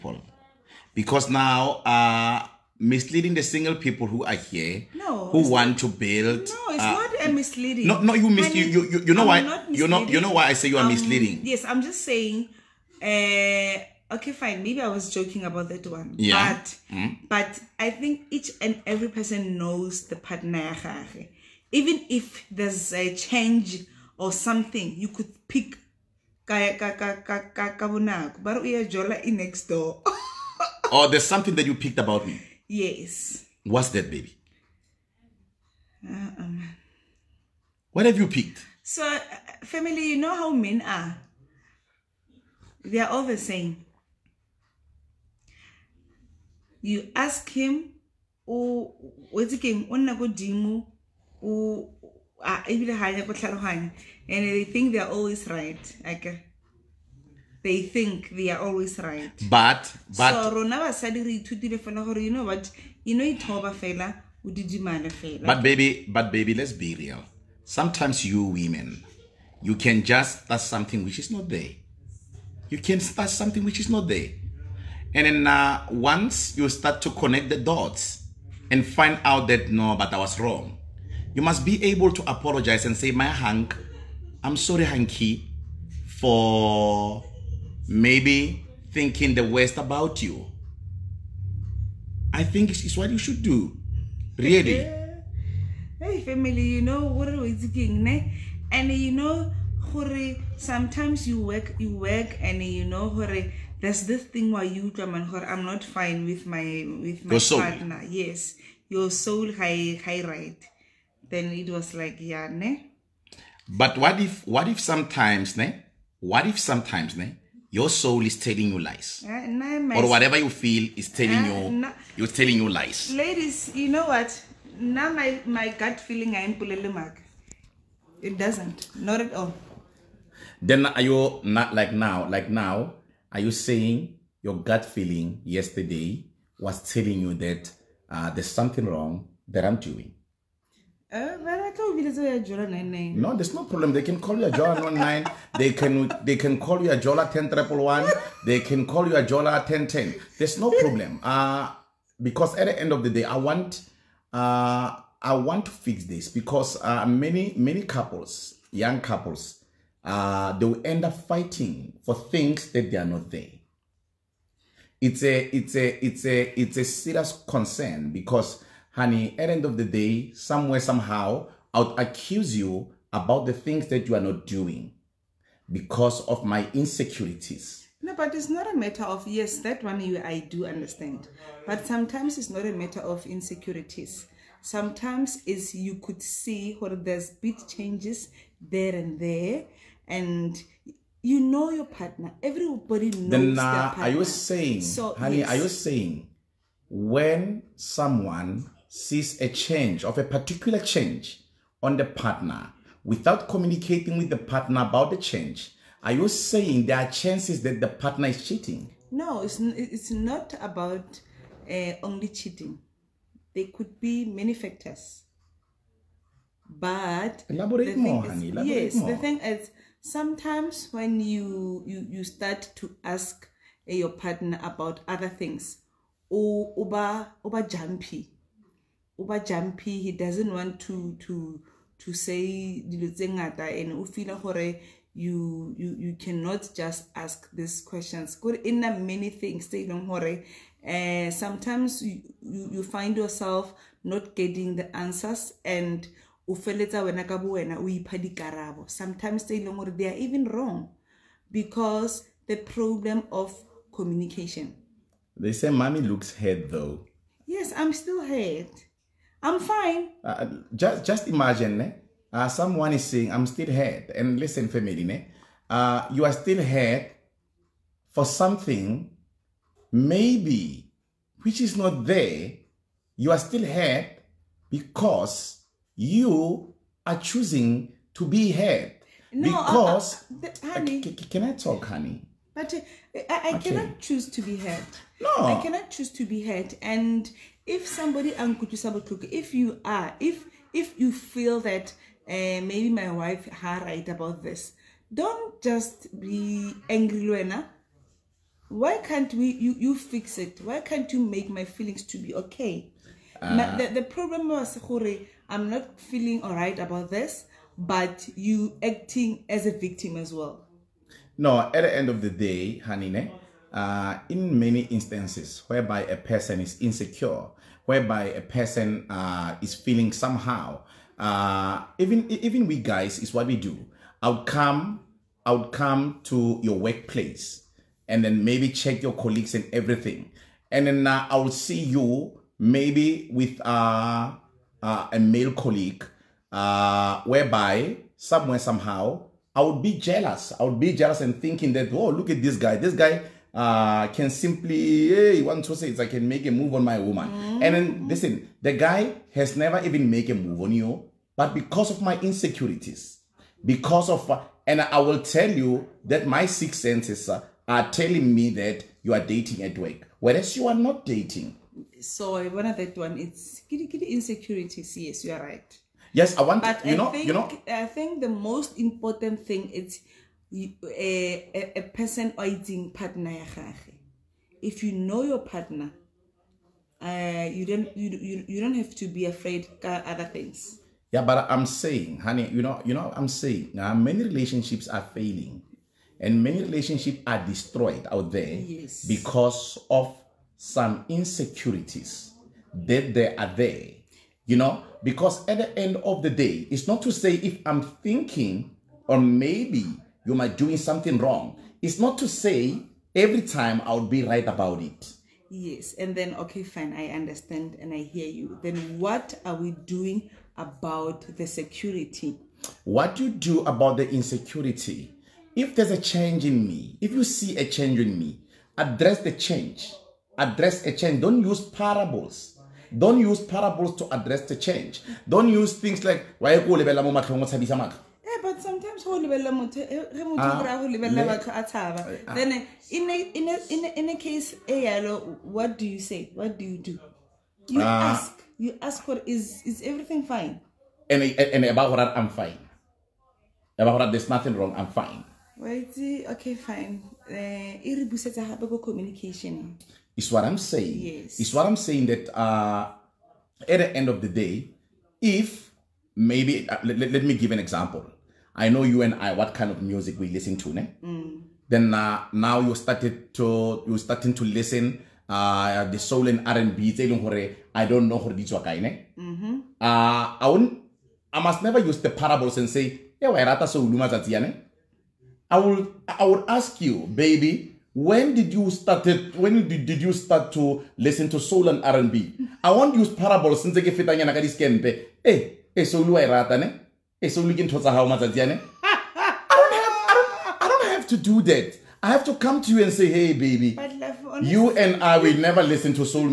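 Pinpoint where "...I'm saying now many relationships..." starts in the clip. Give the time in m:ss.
6:23.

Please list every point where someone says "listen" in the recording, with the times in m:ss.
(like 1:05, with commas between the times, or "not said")
4:24, 5:48, 7:40, 7:44, 8:00, 8:15.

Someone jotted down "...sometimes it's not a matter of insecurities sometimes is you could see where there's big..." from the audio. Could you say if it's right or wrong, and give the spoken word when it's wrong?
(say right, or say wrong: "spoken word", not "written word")
right.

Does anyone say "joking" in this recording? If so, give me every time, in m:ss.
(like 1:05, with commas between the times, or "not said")
0:15.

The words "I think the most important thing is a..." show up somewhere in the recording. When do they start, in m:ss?
6:07.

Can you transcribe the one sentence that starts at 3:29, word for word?
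No, it's it's not about uh, only cheating.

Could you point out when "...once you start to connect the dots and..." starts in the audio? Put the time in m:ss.
1:15.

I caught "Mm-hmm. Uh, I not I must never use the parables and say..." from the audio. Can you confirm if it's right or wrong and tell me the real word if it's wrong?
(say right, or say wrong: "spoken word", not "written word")
right.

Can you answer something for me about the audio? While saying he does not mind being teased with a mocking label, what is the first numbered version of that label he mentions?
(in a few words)
Jola 99.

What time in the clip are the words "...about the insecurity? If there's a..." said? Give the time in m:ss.
6:53.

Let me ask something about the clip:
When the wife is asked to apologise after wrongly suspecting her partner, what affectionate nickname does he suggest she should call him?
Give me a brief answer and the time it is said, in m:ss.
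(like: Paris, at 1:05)
Hanky, at 1:24.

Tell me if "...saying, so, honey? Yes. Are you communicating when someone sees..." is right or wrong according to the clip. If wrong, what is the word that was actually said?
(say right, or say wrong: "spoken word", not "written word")
wrong: "saying", not "communicating".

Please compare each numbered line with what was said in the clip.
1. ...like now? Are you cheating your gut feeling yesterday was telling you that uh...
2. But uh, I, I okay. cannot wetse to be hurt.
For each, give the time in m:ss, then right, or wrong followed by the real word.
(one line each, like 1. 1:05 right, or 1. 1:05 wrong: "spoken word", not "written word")
1. 2:12 wrong: "saying", not "cheating"
2. 4:42 wrong: "choose", not "wetse".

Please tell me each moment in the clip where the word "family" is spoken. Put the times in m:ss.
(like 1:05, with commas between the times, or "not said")
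0:39, 1:36, 4:24.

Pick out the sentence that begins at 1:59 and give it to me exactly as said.
Uh, nah, or whatever you feel is telling uh, you nah.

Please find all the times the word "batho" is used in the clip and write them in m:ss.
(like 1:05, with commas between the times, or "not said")
7:11.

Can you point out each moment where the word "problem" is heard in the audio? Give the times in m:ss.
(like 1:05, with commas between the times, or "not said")
2:23, 2:30, 4:12, 5:04.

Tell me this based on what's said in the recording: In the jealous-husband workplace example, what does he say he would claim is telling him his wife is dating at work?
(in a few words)
six senses.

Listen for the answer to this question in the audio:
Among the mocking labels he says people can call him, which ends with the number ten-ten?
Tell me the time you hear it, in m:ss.
2:29.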